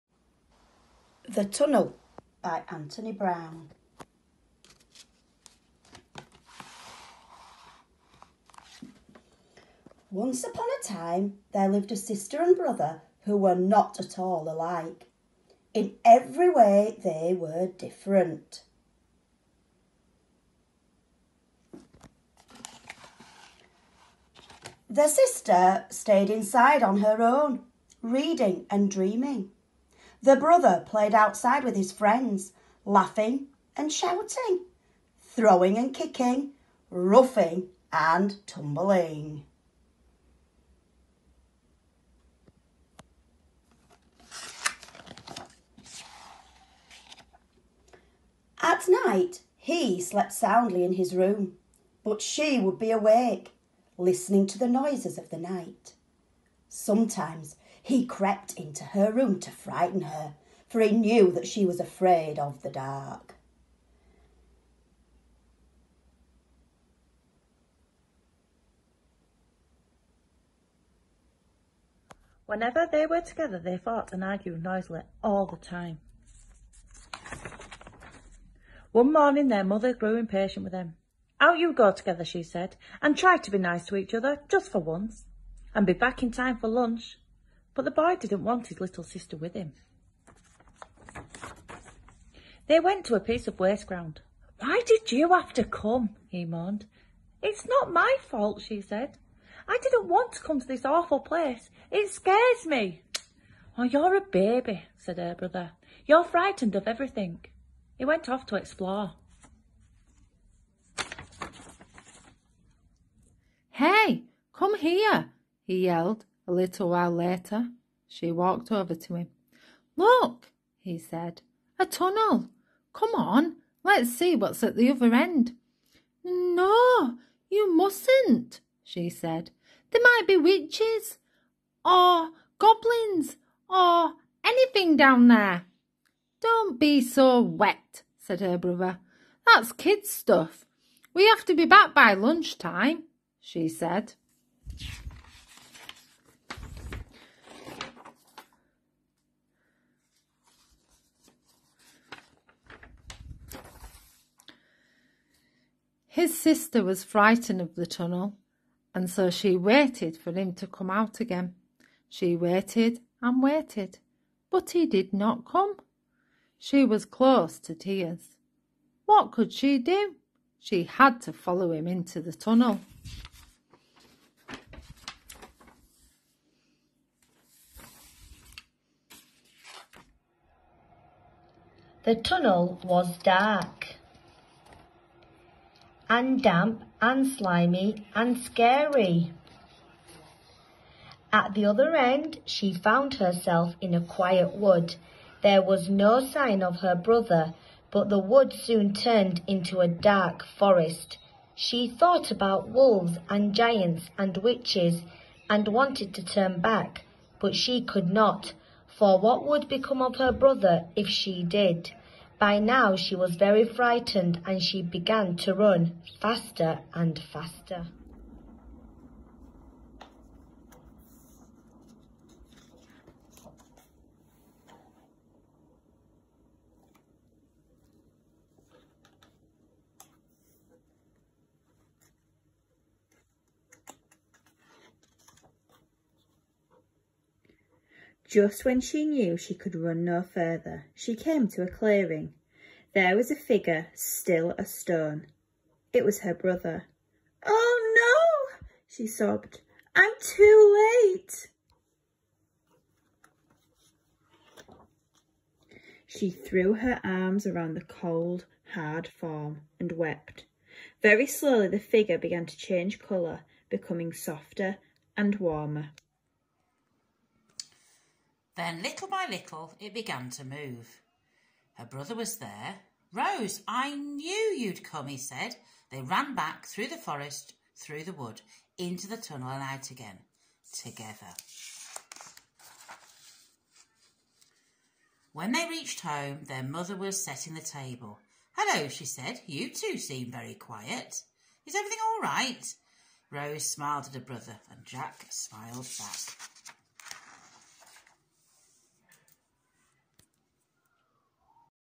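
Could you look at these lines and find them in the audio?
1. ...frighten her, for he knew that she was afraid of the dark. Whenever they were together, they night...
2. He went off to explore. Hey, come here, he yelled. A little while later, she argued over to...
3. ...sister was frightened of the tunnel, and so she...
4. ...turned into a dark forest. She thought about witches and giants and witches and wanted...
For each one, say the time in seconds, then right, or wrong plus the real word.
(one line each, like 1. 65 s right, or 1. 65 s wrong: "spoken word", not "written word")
1. 59 s wrong: "fought", not "night"
2. 107 s wrong: "walked", not "argued"
3. 156 s right
4. 198 s wrong: "wolves", not "witches".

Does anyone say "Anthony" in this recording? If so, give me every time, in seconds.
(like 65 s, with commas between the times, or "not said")
2 s.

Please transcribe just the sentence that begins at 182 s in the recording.
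The tunnel was dark and damp and slimy and scary.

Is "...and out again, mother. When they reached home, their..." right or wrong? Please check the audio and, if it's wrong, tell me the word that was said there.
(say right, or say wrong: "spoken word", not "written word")
wrong: "together", not "mother".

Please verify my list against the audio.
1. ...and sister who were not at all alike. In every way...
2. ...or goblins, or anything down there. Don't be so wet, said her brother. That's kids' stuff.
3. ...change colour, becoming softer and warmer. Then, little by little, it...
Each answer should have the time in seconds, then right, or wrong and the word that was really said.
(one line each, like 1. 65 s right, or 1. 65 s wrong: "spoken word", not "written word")
1. 12 s wrong: "brother", not "sister"
2. 131 s right
3. 262 s right.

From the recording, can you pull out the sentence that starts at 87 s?
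But the boy didn't want his little sister with him.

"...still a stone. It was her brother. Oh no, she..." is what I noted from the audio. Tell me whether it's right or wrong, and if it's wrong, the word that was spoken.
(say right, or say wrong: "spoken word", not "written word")
right.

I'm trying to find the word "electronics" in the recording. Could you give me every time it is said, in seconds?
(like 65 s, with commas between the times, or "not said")
not said.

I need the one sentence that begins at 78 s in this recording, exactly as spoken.
One morning, their mother grew impatient with them.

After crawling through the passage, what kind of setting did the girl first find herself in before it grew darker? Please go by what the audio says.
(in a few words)
a quiet wood.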